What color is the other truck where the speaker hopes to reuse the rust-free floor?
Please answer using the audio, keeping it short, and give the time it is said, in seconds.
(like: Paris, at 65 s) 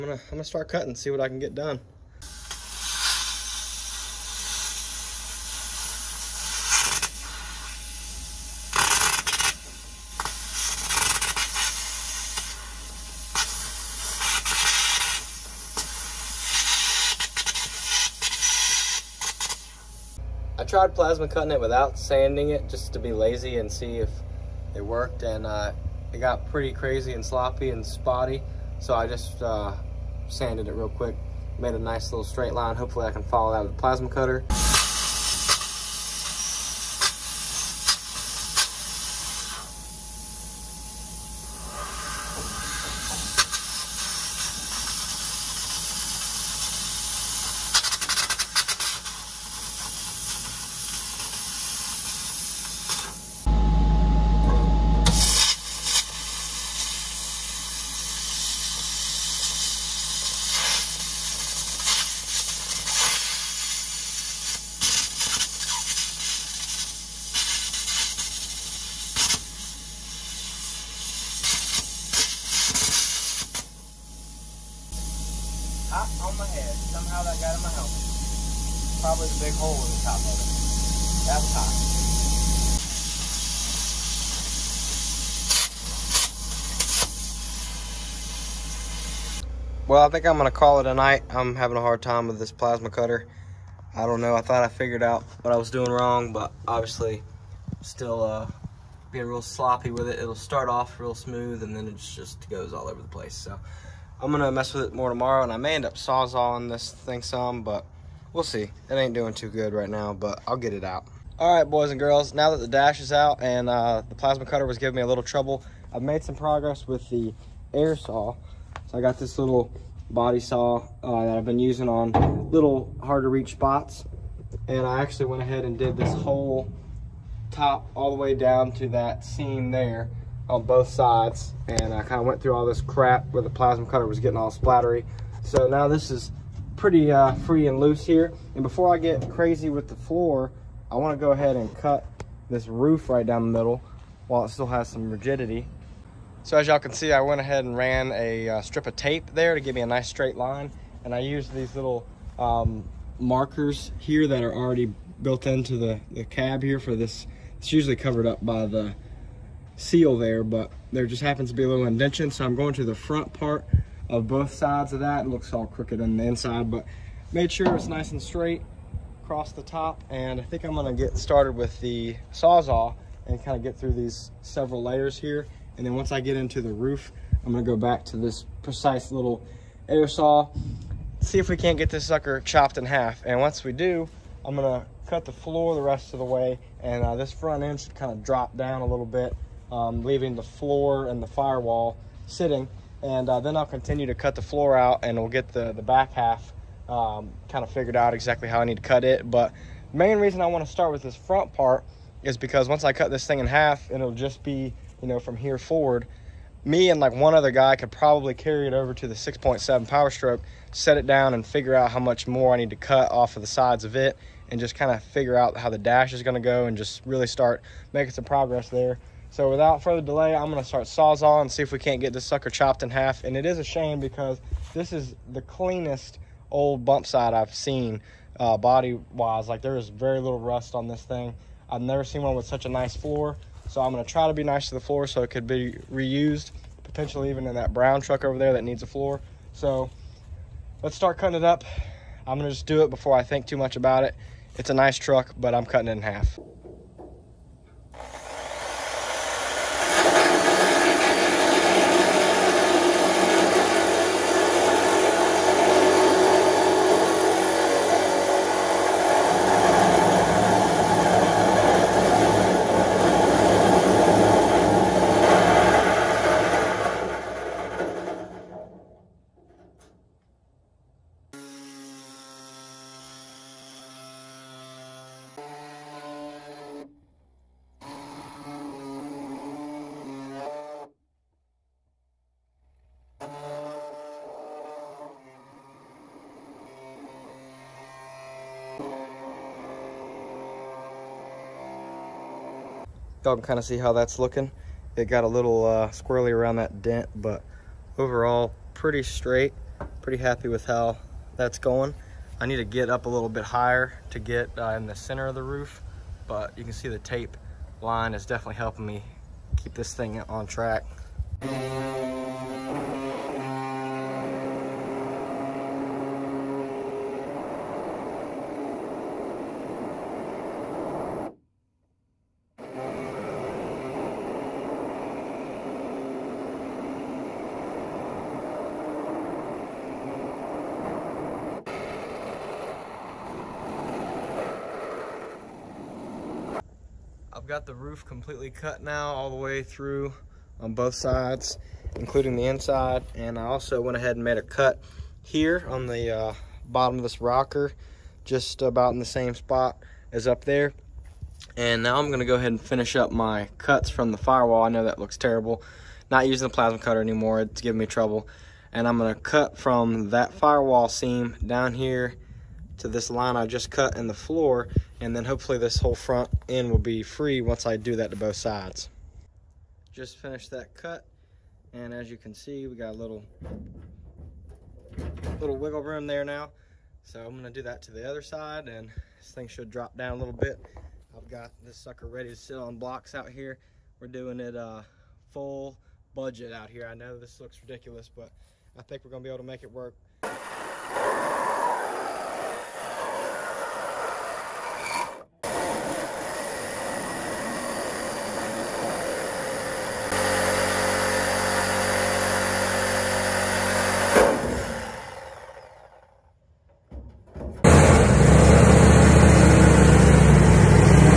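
brown, at 237 s.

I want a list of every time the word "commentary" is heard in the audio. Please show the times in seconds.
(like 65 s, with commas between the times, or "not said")
not said.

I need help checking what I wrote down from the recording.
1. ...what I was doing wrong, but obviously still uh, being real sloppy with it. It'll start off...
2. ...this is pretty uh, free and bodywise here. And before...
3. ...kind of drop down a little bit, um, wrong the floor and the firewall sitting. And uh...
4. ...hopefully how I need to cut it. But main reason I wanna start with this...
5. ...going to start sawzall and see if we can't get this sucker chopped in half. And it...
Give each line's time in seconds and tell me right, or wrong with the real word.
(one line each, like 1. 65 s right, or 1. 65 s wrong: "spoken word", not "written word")
1. 95 s right
2. 135 s wrong: "loose", not "bodywise"
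3. 187 s wrong: "leaving", not "wrong"
4. 198 s wrong: "exactly", not "hopefully"
5. 220 s right.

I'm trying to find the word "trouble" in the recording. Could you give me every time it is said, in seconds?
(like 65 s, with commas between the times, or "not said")
115 s, 357 s.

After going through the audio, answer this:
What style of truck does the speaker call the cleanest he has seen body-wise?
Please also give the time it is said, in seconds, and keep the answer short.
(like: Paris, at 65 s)
bump side, at 226 s.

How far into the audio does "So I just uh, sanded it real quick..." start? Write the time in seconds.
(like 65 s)
28 s.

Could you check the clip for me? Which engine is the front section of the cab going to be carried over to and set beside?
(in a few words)
6.7 Power Stroke.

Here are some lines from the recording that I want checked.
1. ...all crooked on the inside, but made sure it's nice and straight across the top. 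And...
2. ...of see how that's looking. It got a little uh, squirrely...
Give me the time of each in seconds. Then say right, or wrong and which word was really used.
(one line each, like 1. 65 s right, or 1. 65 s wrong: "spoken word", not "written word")
1. 165 s right
2. 293 s right.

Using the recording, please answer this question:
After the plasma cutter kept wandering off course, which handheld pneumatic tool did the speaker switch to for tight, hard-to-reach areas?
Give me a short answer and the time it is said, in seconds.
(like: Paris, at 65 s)
body saw, at 120 s.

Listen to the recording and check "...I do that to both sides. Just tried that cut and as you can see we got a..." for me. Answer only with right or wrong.
wrong.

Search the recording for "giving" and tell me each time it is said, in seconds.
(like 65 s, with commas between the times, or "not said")
114 s, 357 s.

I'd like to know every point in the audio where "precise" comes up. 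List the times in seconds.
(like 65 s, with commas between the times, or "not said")
178 s.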